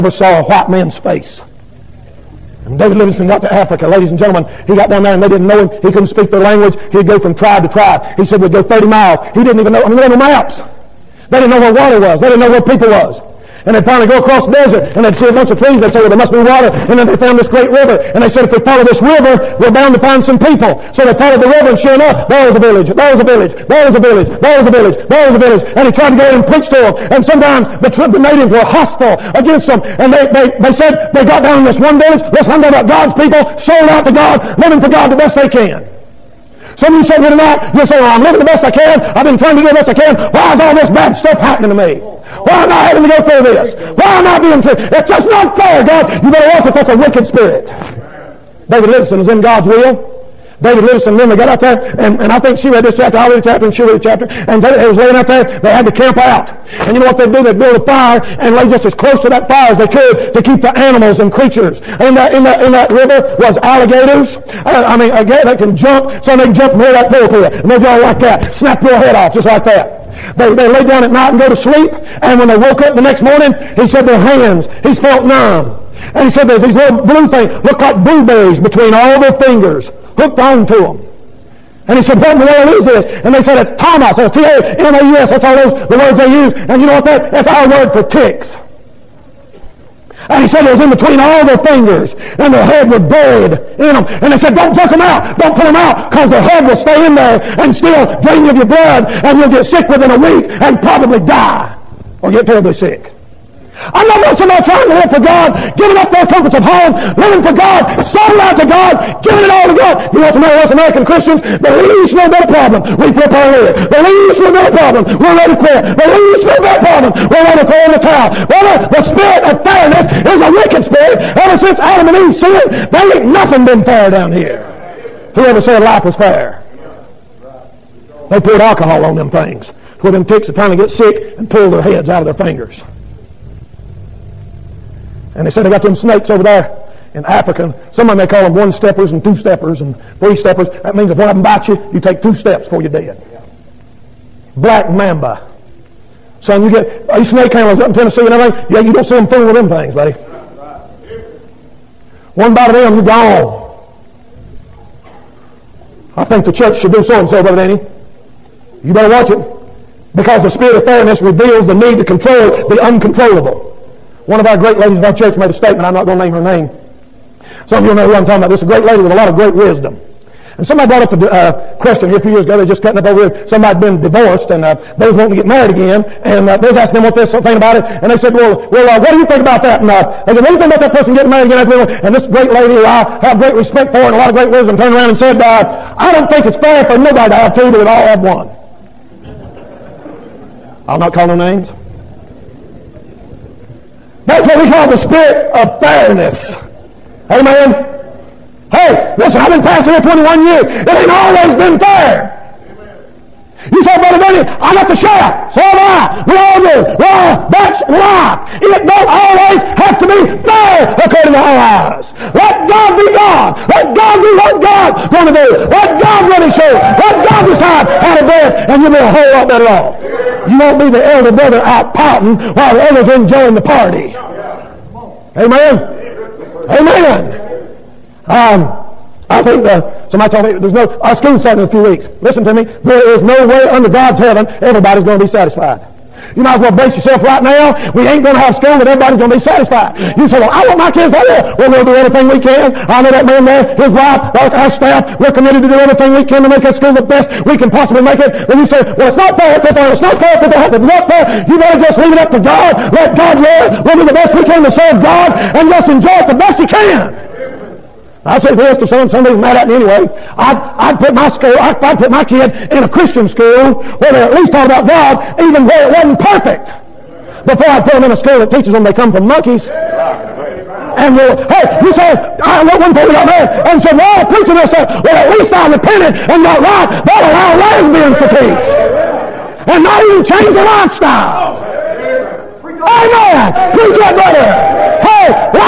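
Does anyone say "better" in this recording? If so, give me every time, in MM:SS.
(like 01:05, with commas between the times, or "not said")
00:46, 02:38, 03:39, 04:11.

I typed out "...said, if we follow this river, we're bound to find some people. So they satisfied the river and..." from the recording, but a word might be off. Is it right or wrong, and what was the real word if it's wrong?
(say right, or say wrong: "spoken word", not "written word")
wrong: "followed", not "satisfied".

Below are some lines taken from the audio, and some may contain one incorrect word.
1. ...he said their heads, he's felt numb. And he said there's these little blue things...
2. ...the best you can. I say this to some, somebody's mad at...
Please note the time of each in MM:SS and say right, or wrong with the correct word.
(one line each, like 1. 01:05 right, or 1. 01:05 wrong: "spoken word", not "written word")
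1. 01:13 wrong: "hands", not "heads"
2. 04:16 right.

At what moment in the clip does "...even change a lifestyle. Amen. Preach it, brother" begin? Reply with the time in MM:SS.
04:39.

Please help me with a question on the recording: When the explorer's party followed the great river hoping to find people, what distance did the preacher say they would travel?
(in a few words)
30 miles.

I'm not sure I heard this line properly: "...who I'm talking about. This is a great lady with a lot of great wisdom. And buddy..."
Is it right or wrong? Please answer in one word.
wrong.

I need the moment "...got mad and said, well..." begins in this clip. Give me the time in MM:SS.
04:33.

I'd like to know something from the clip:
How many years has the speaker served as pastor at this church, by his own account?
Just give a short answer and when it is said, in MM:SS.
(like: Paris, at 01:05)
21, at 03:19.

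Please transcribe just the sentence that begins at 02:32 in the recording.
One bite of them, you're gone.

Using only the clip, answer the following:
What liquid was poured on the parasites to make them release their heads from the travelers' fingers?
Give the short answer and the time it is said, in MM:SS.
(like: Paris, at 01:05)
Alcohol, at 02:08.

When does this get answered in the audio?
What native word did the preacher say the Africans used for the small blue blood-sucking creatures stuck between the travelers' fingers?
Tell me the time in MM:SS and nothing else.
01:24.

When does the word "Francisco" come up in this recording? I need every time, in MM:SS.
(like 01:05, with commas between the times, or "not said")
not said.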